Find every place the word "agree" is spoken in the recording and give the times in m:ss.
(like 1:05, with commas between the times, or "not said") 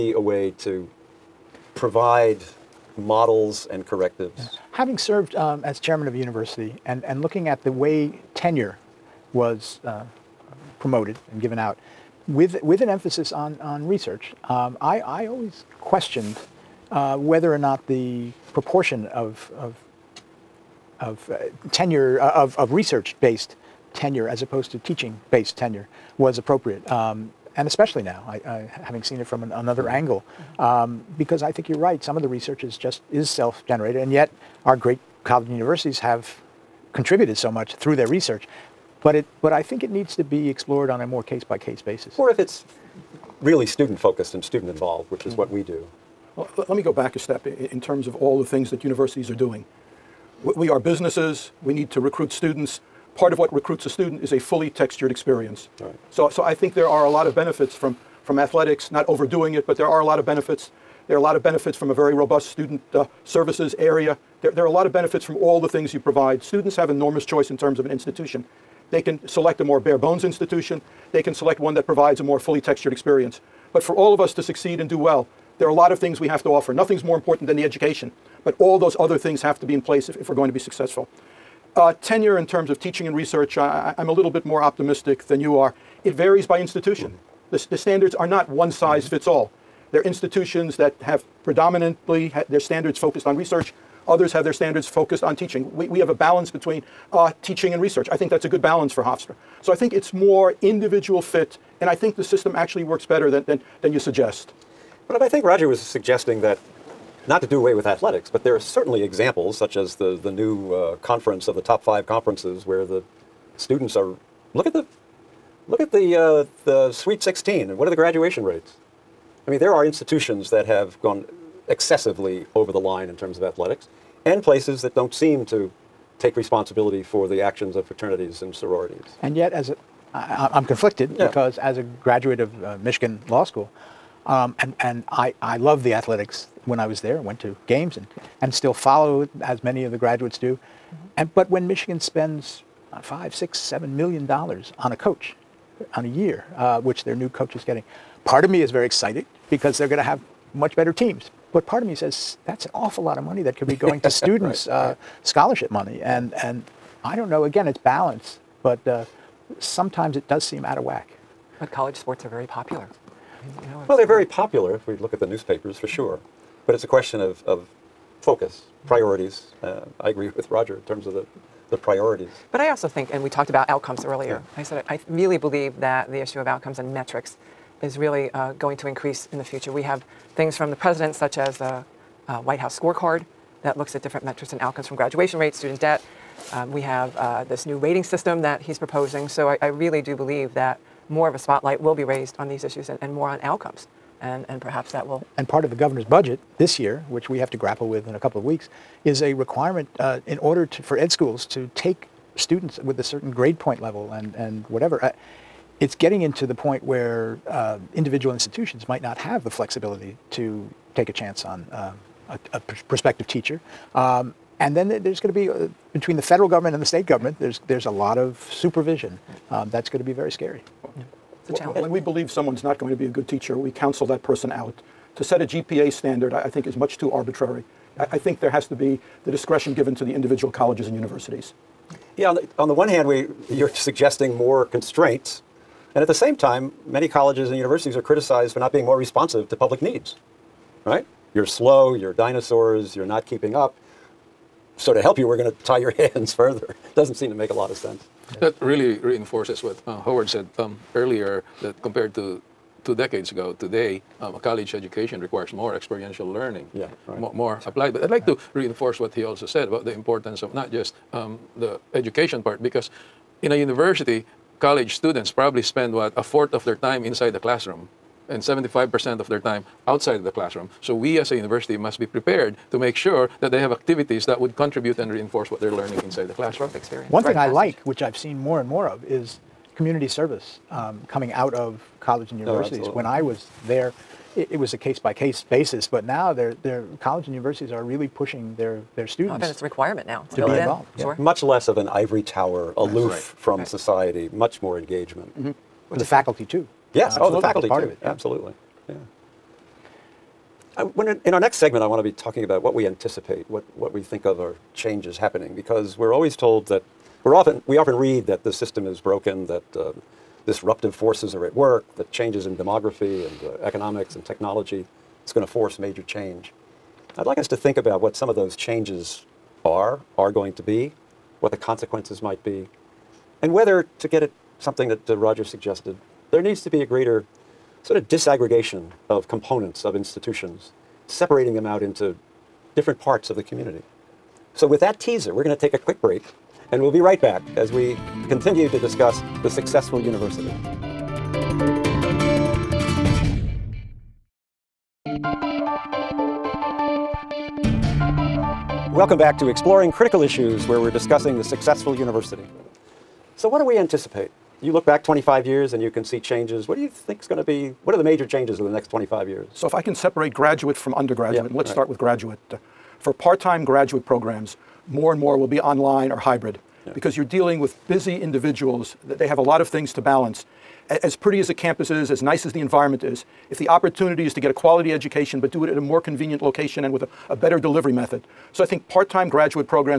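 2:50.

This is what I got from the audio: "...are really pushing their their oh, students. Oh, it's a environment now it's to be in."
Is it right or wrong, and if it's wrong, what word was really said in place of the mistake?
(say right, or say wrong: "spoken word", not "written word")
wrong: "requirement", not "environment".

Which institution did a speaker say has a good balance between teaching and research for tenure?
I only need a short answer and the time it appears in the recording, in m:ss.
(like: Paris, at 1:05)
Hofstra, at 1:39.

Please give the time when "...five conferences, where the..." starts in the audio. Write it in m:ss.
1:51.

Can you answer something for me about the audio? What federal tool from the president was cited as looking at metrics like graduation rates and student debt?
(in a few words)
White House scorecard.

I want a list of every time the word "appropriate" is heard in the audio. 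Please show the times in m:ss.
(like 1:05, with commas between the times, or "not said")
0:26.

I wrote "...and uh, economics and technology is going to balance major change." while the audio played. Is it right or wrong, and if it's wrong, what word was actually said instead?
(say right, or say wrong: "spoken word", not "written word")
wrong: "force", not "balance".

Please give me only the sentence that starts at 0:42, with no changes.
Or if it's really student focused and student involved, which is mm -hmm.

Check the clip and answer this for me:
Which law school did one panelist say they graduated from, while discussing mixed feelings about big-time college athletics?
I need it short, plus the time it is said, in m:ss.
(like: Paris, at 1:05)
Michigan Law School, at 2:12.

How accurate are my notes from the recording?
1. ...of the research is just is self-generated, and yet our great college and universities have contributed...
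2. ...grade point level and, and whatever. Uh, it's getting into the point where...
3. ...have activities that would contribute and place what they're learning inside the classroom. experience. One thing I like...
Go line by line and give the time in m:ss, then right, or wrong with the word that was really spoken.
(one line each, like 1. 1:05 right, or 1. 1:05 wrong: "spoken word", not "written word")
1. 0:32 right
2. 3:23 right
3. 4:33 wrong: "reinforce", not "place".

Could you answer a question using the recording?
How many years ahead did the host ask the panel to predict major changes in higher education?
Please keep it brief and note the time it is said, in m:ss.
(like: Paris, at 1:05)
25, at 5:58.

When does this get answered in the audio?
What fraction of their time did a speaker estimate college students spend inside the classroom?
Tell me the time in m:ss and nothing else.
4:26.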